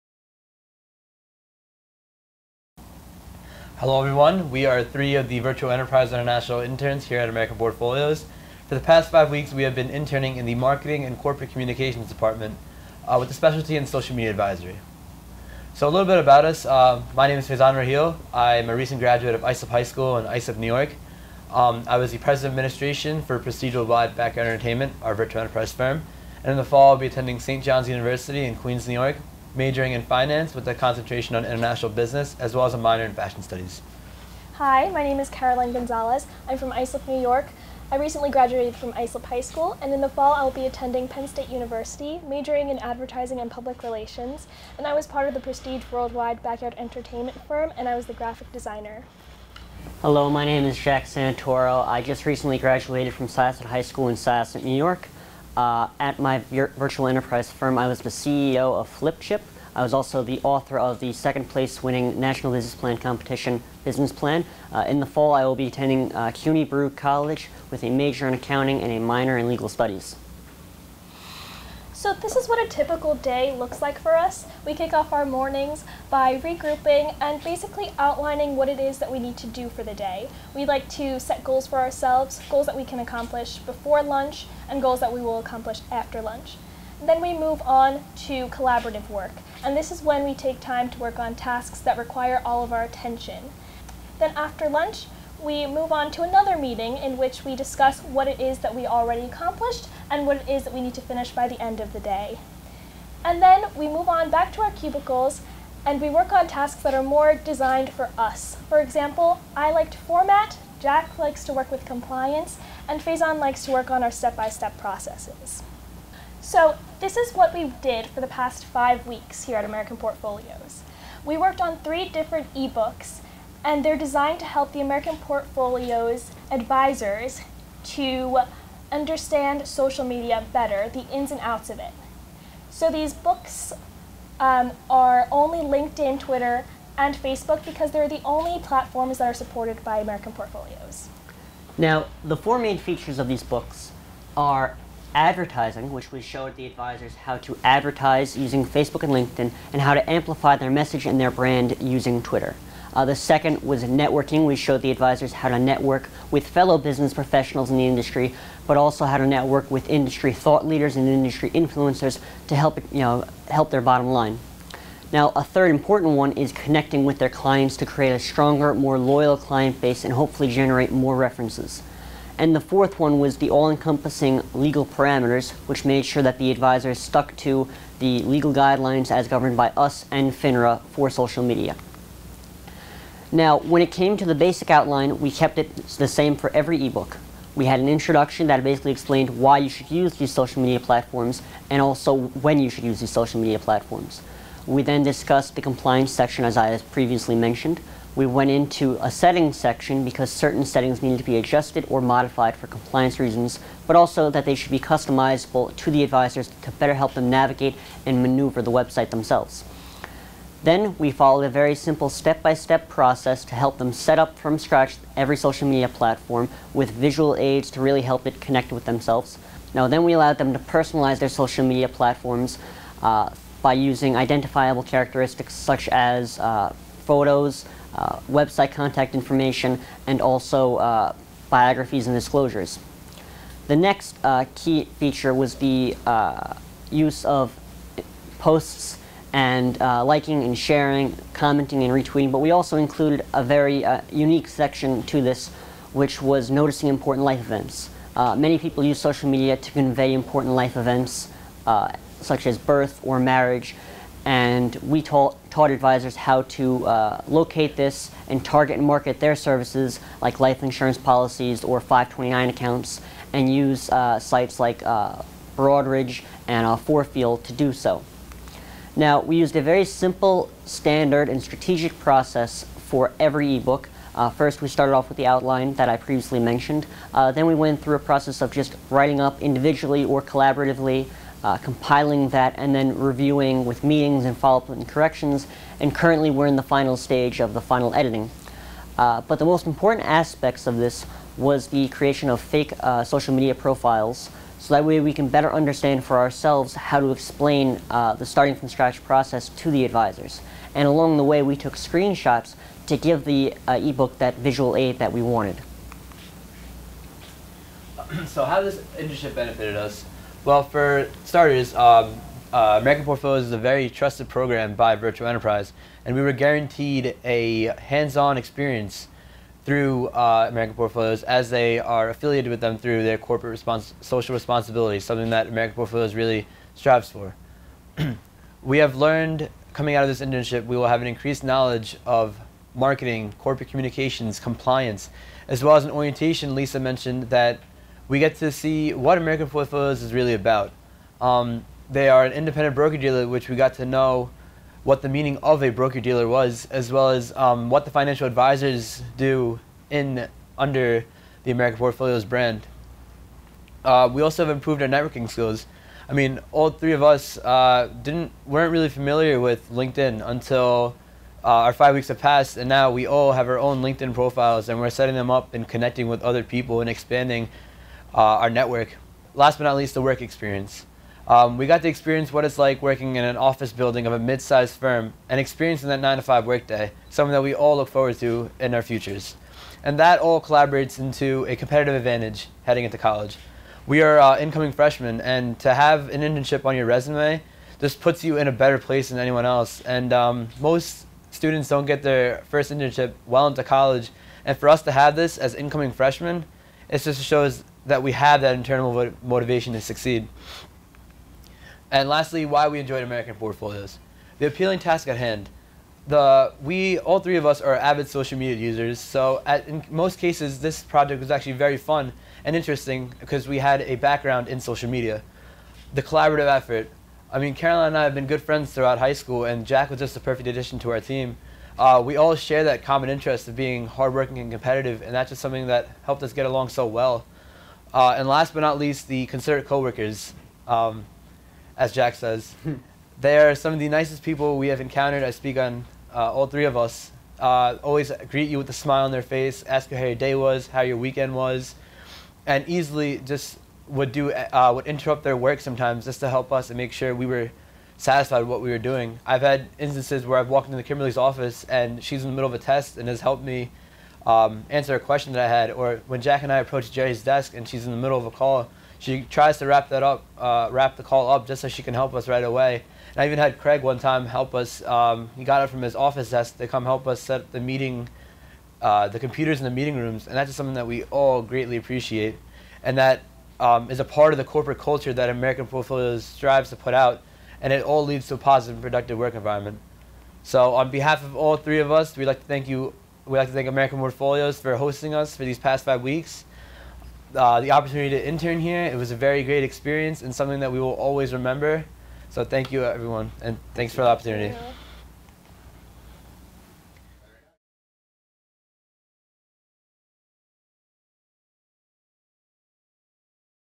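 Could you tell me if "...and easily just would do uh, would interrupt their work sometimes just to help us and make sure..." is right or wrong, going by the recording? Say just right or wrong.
right.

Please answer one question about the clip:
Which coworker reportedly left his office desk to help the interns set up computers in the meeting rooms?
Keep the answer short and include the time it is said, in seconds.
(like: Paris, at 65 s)
Craig, at 463 s.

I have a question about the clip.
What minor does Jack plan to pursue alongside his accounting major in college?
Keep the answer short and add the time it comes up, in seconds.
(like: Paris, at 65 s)
legal studies, at 69 s.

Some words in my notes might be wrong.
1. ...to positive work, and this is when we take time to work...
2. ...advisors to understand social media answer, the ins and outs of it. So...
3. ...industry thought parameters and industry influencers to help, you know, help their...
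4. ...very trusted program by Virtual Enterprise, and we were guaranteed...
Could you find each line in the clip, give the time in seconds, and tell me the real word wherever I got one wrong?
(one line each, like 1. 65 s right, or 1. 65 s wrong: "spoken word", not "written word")
1. 88 s wrong: "collaborative", not "positive"
2. 126 s wrong: "better", not "answer"
3. 159 s wrong: "leaders", not "parameters"
4. 313 s right.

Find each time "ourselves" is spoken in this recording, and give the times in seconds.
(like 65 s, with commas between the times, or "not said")
81 s, 296 s.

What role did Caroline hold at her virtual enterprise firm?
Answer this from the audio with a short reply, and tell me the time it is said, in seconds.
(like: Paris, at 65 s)
graphic designer, at 48 s.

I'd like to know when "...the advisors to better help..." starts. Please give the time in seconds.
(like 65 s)
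205 s.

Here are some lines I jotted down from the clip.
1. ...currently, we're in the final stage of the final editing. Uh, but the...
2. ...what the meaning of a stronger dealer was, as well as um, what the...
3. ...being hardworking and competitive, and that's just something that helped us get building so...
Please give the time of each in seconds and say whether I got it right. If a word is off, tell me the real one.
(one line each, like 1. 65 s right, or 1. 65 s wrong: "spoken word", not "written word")
1. 285 s right
2. 344 s wrong: "broker", not "stronger"
3. 423 s wrong: "along", not "building".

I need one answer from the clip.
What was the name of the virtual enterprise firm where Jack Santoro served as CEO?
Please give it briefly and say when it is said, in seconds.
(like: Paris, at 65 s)
Flipchip, at 58 s.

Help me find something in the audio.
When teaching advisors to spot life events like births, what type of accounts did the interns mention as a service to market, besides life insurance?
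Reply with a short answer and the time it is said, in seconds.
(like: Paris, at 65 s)
529 accounts, at 261 s.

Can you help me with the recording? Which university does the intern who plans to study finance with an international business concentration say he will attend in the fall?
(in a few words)
St. John's University.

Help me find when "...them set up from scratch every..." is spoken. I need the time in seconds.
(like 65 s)
213 s.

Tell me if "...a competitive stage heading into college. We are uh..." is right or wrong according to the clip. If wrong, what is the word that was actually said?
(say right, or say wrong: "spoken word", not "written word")
wrong: "advantage", not "stage".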